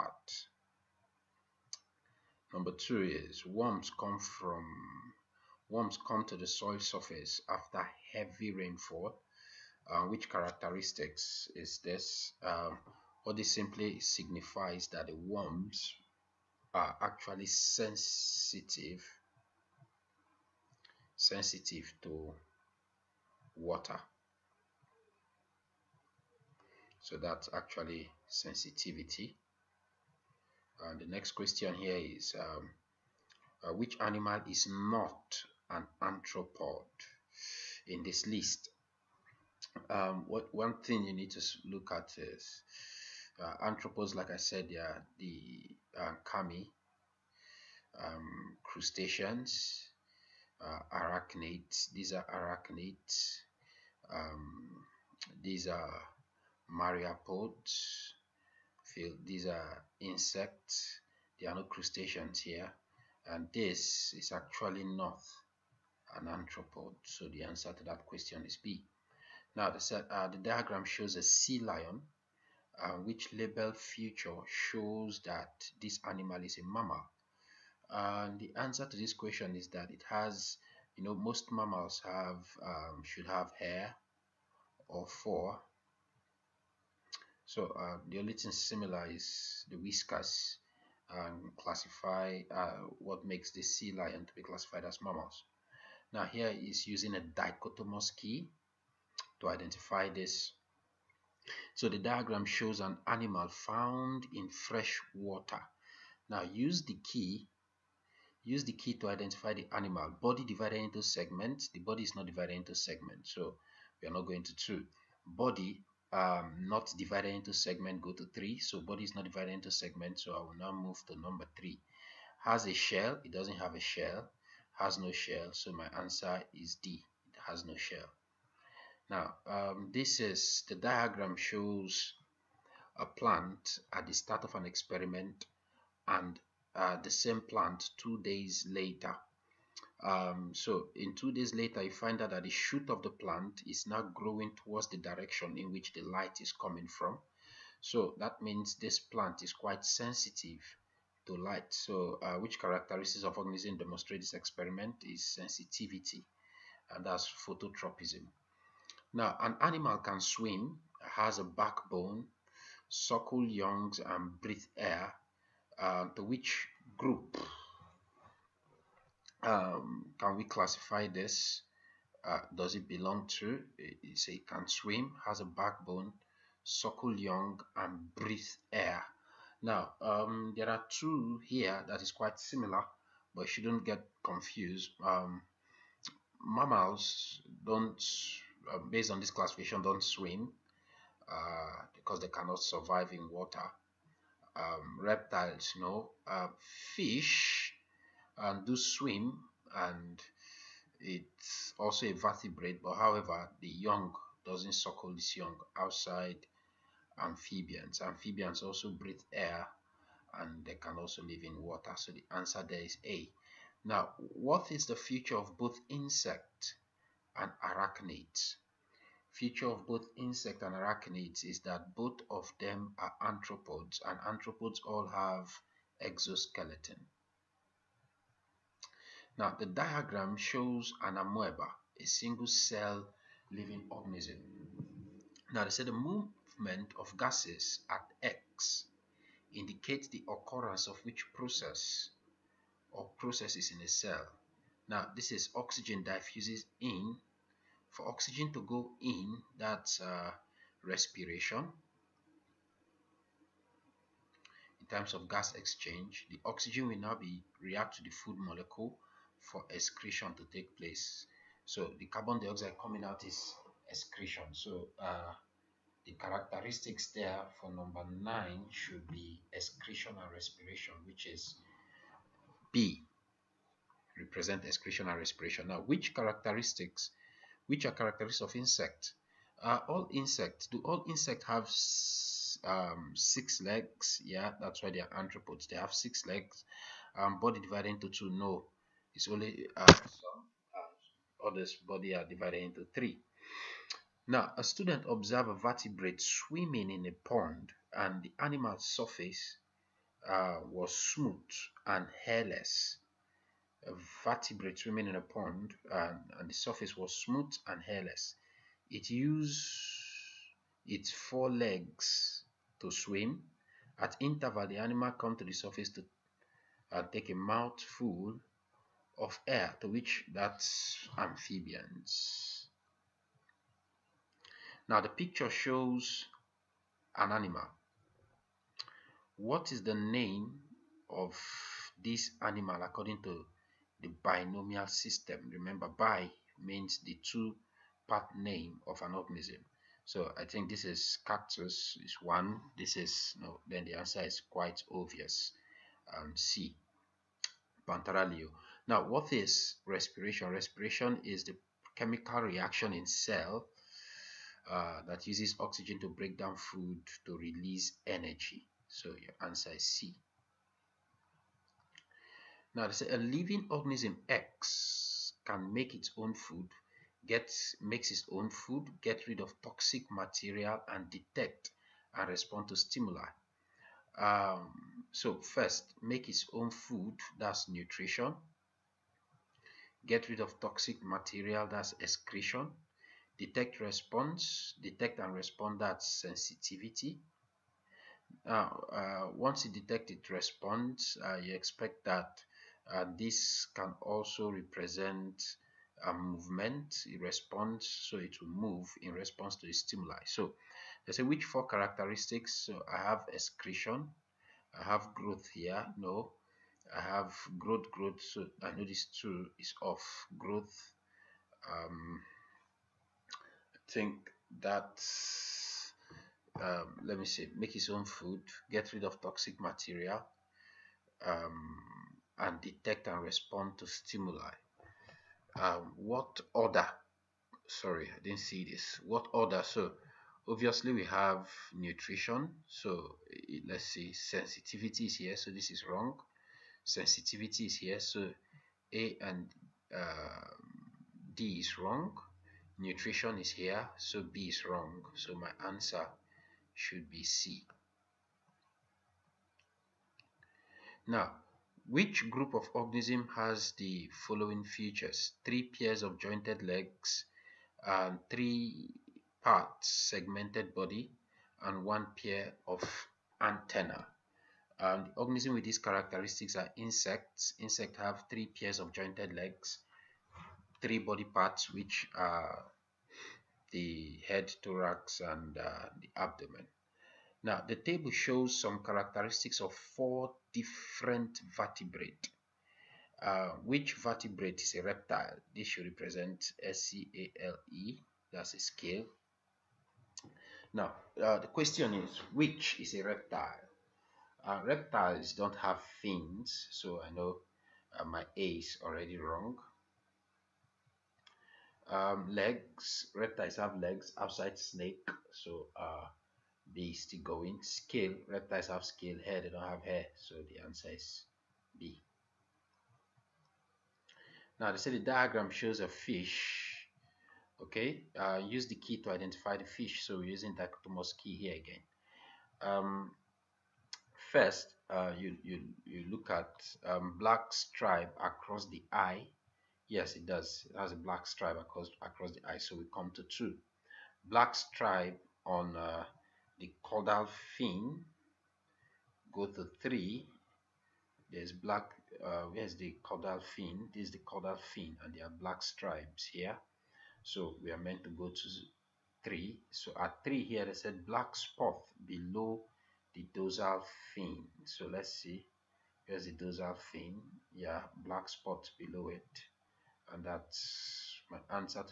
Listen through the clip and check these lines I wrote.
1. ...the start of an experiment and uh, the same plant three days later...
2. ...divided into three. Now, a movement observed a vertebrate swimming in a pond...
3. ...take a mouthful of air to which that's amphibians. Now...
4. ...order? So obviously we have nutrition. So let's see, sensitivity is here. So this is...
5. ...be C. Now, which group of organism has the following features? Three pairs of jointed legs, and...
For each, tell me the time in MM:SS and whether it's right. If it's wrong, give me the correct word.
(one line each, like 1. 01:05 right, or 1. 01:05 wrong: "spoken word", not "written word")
1. 02:14 wrong: "two", not "three"
2. 04:52 wrong: "student", not "movement"
3. 05:17 right
4. 07:09 right
5. 07:27 right.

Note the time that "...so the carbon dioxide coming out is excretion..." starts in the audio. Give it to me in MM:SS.
04:21.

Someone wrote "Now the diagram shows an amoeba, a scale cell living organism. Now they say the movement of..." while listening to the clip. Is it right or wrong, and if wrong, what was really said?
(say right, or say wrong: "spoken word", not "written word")
wrong: "single", not "scale".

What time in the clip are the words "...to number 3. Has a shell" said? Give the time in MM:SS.
02:01.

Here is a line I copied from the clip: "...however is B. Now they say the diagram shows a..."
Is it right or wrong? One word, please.
wrong.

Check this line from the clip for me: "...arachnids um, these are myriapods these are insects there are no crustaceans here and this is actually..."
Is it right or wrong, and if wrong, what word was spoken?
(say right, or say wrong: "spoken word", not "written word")
right.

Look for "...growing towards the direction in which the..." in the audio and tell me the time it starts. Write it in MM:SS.
02:24.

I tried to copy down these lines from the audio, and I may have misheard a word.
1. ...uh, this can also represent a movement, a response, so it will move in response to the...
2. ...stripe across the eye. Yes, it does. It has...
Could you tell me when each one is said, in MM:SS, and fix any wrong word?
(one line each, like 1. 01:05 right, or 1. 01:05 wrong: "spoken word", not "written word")
1. 06:32 right
2. 08:47 right.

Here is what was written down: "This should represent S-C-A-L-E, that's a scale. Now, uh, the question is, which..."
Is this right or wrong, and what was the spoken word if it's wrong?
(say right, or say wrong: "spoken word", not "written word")
right.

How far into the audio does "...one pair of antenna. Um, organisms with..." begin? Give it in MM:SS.
07:41.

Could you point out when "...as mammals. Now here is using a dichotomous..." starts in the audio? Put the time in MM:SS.
01:34.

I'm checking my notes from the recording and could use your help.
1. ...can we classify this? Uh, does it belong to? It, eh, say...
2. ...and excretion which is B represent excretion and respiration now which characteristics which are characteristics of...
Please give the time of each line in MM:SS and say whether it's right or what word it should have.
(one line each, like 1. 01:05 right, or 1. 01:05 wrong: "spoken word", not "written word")
1. 02:50 right
2. 04:30 wrong: "respiration", not "excretion".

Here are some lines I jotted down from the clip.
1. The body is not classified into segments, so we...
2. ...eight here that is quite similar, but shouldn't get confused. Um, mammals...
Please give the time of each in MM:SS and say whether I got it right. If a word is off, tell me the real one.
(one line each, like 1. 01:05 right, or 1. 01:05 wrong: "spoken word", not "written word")
1. 01:51 wrong: "divided", not "classified"
2. 03:00 wrong: "two", not "eight".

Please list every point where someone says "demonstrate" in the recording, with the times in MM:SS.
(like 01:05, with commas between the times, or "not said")
02:33.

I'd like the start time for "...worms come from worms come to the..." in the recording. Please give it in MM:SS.
00:03.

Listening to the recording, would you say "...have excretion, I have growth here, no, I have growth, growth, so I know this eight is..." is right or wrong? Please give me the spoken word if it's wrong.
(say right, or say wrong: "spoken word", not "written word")
wrong: "two", not "eight".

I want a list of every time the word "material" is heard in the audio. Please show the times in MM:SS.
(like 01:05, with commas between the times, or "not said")
06:10, 06:21, 06:59.